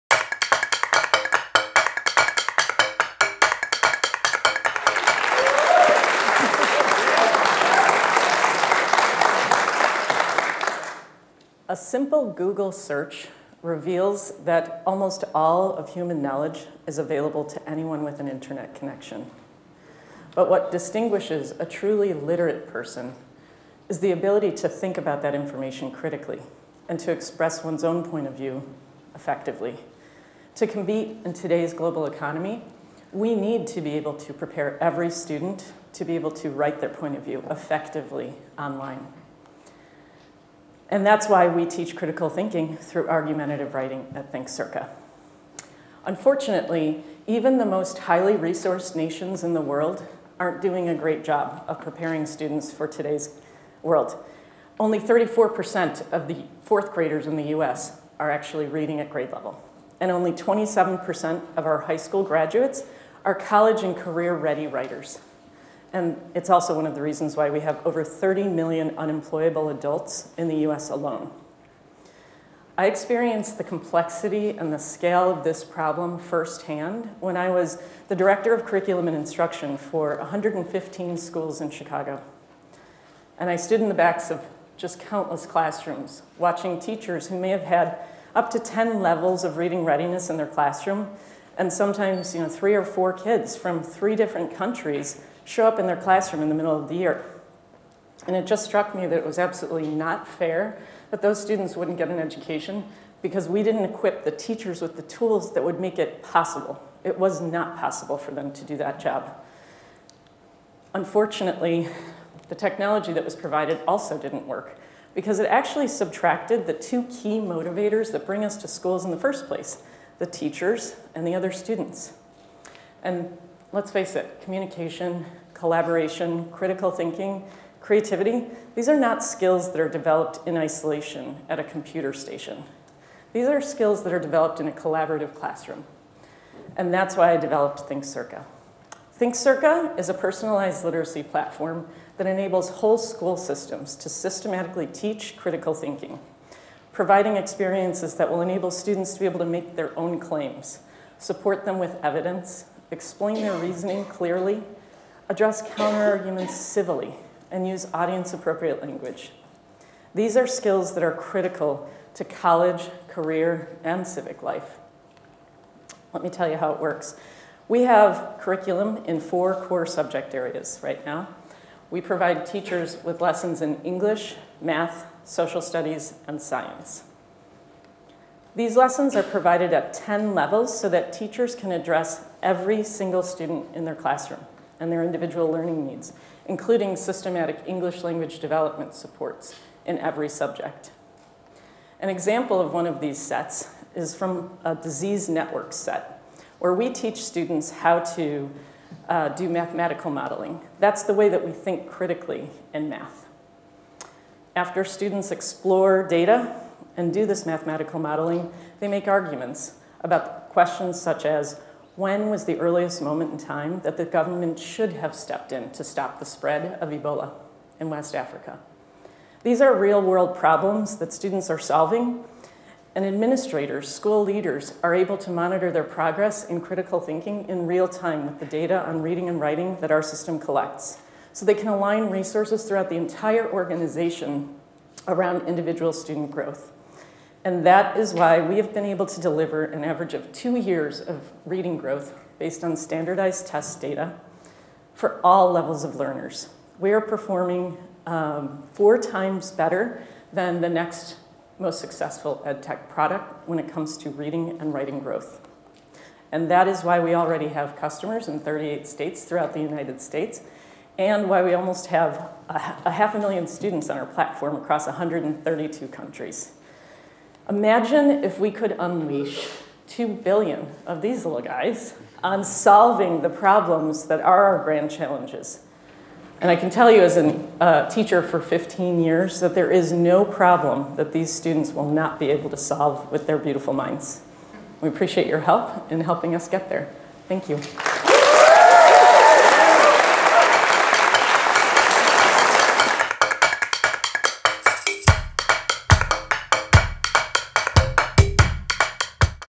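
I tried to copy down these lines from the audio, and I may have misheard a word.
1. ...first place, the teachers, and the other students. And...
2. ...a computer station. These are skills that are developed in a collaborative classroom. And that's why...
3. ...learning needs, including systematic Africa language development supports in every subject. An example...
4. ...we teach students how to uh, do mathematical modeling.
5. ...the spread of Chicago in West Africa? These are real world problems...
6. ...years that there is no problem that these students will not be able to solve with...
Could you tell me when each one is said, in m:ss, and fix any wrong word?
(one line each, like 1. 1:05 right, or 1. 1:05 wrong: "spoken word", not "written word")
1. 1:59 right
2. 2:11 right
3. 3:05 wrong: "English", not "Africa"
4. 3:16 right
5. 3:36 wrong: "Ebola", not "Chicago"
6. 4:39 right.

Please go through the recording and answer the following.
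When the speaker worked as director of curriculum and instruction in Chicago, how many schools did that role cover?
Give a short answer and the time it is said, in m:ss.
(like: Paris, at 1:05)
115, at 1:20.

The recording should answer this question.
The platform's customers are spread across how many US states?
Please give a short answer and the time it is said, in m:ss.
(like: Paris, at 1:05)
38, at 4:18.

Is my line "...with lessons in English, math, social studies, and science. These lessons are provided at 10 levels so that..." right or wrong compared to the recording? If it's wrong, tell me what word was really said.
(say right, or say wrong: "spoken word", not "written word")
right.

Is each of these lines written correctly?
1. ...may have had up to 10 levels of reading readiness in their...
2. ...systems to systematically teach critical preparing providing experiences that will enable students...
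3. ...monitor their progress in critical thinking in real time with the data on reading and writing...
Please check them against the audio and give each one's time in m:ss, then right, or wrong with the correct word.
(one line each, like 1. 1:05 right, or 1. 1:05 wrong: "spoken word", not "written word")
1. 1:27 right
2. 2:23 wrong: "thinking", not "preparing"
3. 3:45 right.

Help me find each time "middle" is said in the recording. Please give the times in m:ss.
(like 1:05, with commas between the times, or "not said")
1:36.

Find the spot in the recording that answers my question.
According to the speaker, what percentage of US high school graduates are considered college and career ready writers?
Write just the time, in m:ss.
1:00.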